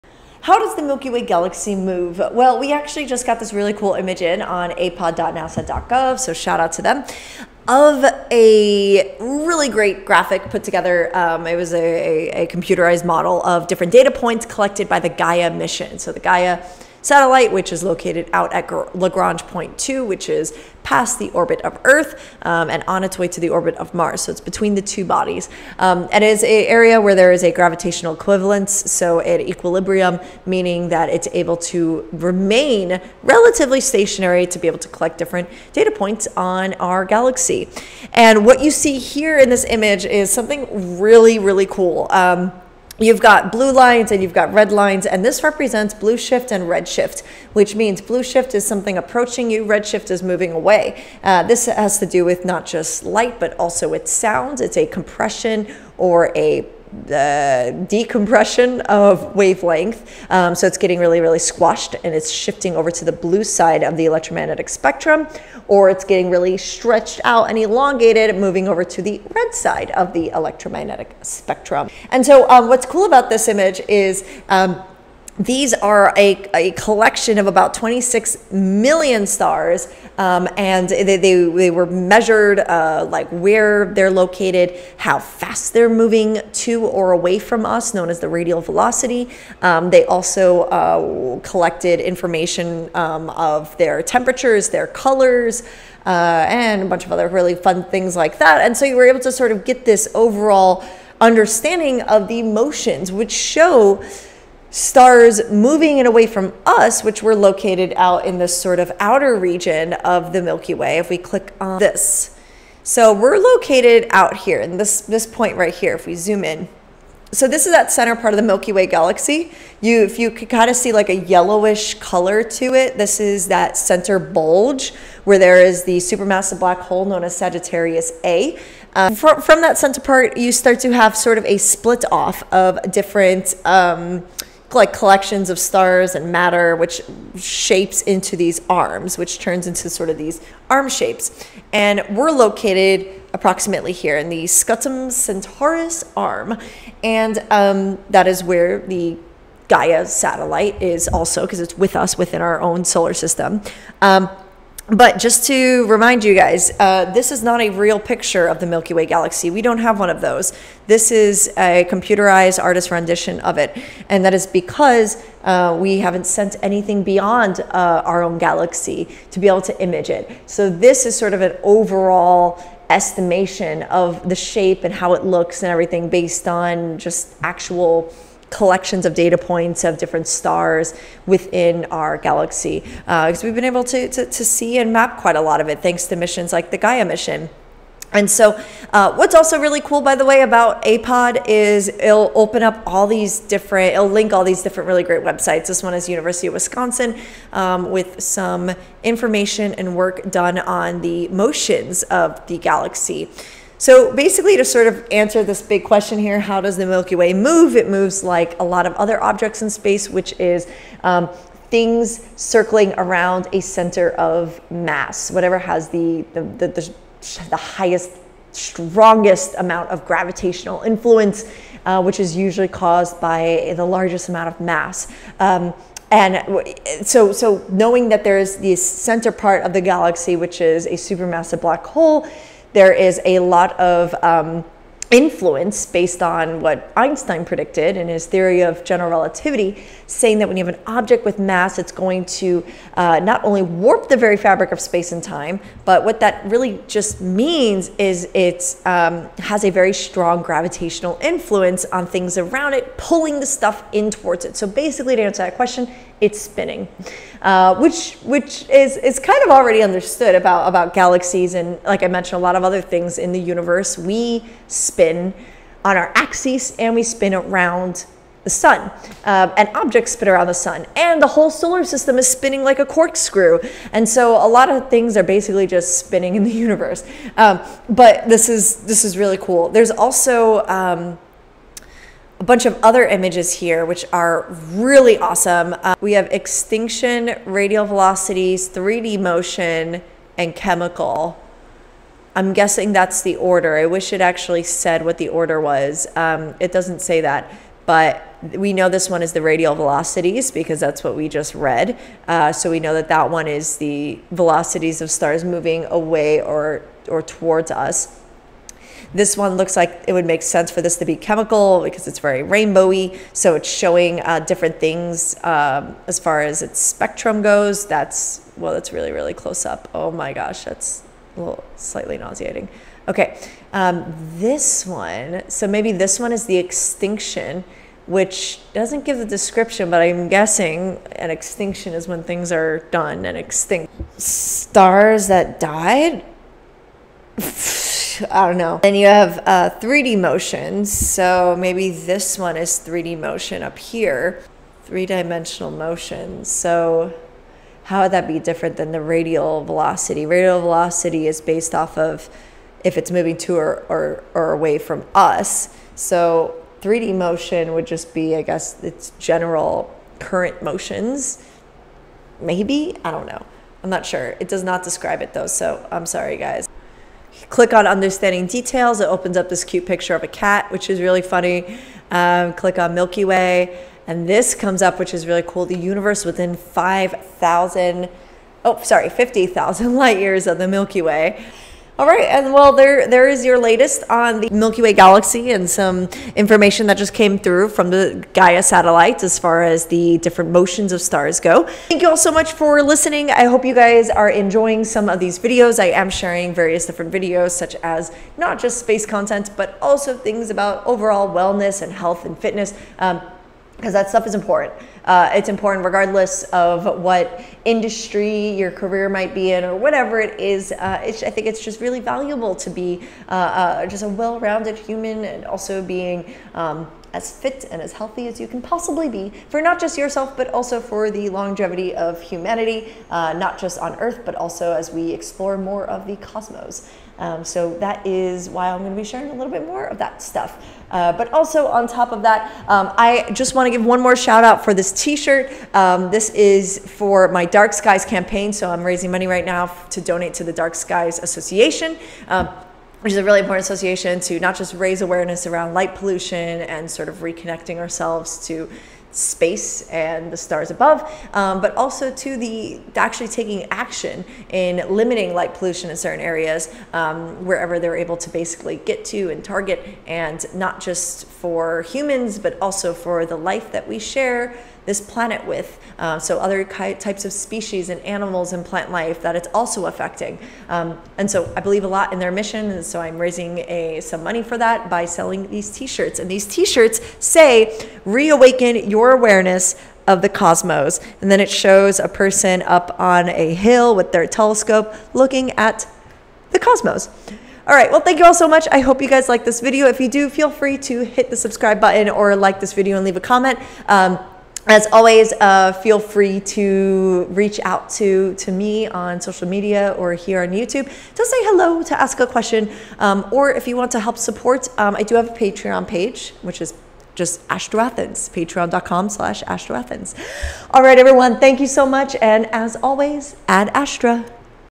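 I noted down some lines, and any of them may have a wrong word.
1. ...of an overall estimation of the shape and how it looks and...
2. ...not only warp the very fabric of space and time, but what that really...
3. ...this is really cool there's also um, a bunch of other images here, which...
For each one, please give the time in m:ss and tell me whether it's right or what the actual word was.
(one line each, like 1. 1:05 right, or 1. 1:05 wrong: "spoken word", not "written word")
1. 2:51 right
2. 4:03 right
3. 4:38 right.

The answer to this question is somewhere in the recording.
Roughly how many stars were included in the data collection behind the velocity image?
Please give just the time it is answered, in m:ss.
1:17.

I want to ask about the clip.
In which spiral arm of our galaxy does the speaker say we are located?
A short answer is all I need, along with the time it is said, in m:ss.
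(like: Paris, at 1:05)
Scutum Centaurus arm, at 2:24.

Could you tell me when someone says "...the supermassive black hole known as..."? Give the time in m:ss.
2:05.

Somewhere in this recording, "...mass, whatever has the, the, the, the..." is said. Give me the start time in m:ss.
3:34.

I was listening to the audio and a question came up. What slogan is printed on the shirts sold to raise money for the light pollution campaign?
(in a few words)
Reawaken your awareness.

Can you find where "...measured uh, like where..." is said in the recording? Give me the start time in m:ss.
1:21.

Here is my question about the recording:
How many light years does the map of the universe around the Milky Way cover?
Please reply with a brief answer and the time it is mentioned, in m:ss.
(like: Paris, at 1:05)
50,000, at 6:19.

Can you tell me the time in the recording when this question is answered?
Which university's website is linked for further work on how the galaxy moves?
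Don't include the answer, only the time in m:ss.
3:16.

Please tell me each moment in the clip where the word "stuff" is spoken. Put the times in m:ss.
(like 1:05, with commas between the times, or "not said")
4:13, 6:44, 7:10.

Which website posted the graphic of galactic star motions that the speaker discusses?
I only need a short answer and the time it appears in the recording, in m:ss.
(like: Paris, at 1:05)
apod.nasa.gov, at 0:04.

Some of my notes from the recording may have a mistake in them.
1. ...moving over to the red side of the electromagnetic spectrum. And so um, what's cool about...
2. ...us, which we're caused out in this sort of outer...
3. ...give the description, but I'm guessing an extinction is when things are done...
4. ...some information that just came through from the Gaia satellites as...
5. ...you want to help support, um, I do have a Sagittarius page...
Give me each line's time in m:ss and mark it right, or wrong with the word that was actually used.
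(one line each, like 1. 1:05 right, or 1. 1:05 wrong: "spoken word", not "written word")
1. 1:08 right
2. 1:46 wrong: "located", not "caused"
3. 5:29 right
4. 6:25 right
5. 8:23 wrong: "Patreon", not "Sagittarius".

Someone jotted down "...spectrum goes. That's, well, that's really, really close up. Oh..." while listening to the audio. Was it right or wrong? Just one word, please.
right.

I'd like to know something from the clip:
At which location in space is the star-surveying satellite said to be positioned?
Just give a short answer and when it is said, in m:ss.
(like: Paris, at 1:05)
Lagrange Point 2, at 0:18.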